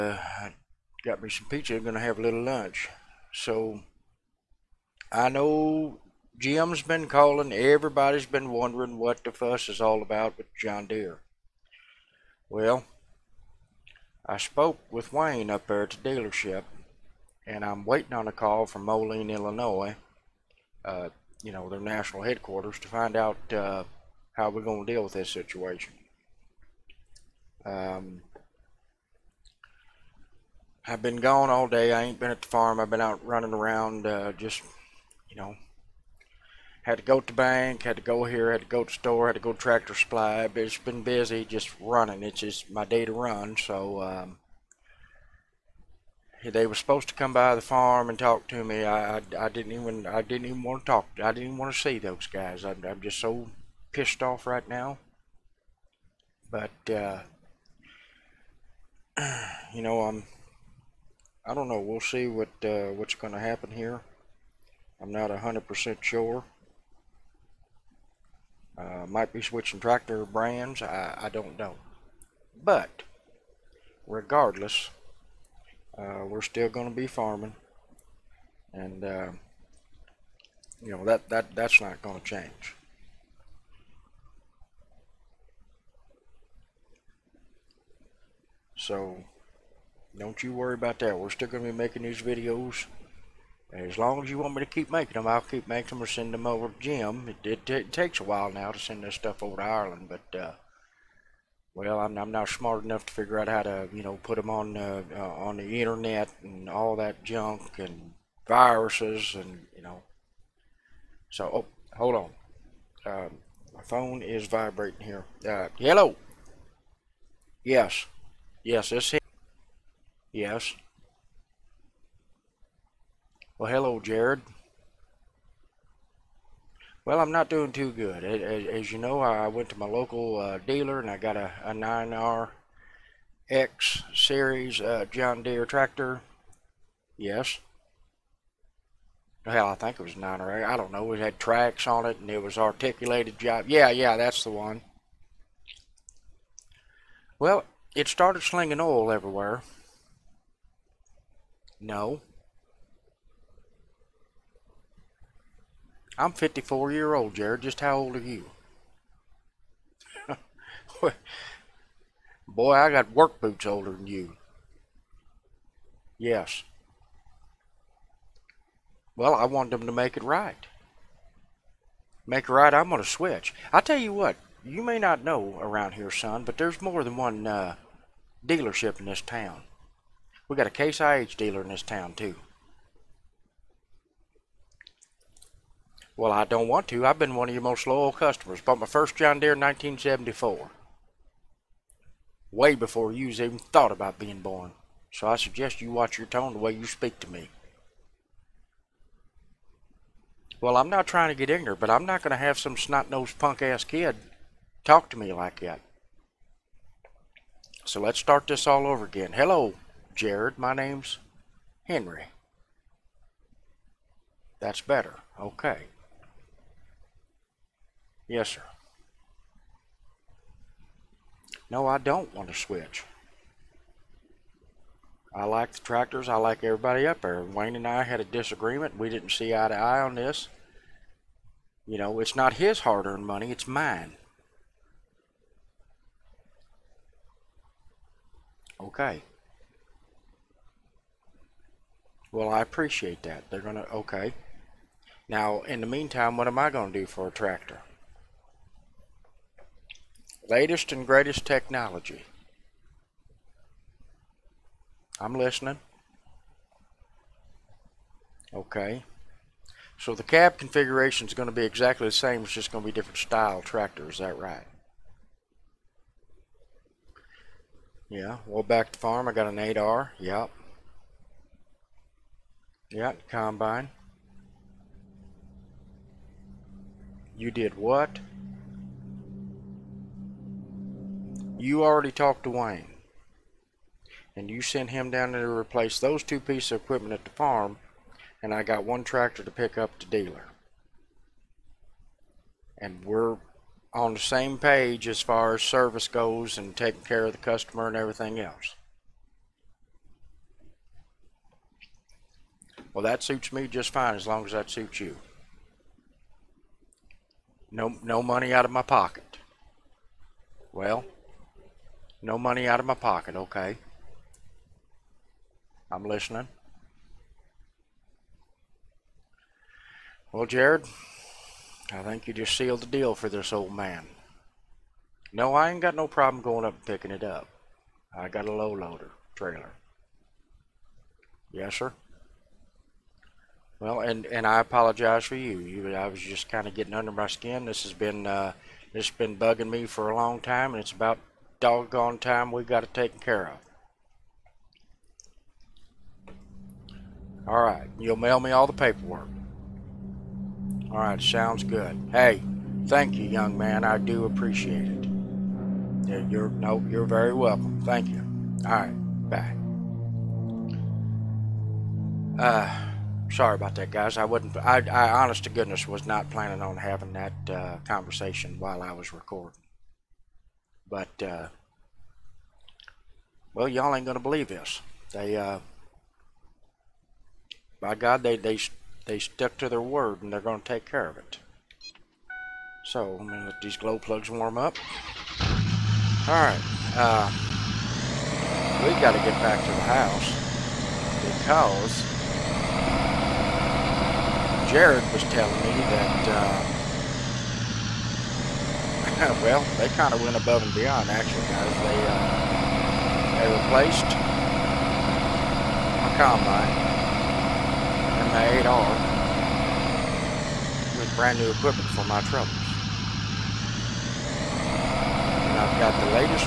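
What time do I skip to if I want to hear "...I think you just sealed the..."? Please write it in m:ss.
5:21.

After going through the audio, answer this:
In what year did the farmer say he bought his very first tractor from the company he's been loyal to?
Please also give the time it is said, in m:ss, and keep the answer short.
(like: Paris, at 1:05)
1974, at 3:09.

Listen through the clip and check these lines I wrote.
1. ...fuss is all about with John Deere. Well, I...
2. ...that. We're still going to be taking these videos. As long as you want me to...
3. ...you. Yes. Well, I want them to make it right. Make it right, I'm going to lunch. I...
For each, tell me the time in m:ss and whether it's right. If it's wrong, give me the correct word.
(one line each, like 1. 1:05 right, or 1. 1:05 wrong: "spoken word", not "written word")
1. 0:09 right
2. 1:30 wrong: "making", not "taking"
3. 2:44 wrong: "switch", not "lunch".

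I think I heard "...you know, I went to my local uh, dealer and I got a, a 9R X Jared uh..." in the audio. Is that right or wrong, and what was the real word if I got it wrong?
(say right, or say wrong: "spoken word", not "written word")
wrong: "Series", not "Jared".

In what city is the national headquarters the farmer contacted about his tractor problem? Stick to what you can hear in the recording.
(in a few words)
Moline, Illinois.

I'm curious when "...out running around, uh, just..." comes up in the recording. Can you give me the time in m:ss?
0:33.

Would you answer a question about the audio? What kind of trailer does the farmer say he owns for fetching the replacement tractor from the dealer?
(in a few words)
low loader trailer.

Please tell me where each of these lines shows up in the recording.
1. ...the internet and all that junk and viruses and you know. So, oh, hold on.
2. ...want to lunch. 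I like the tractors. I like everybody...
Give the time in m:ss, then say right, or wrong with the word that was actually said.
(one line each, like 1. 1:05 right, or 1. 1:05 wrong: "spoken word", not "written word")
1. 1:45 right
2. 3:42 wrong: "switch", not "lunch".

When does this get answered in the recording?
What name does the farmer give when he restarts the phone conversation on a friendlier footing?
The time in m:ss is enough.
3:31.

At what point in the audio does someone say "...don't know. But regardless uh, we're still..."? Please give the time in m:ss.
1:11.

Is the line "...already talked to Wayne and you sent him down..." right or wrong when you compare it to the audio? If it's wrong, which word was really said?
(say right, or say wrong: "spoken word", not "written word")
right.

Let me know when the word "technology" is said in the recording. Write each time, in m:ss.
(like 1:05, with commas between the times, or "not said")
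4:11.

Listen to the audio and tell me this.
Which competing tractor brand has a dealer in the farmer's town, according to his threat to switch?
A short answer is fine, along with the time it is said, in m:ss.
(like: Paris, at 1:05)
Case IH, at 3:00.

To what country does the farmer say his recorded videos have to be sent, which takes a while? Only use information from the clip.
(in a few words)
Ireland.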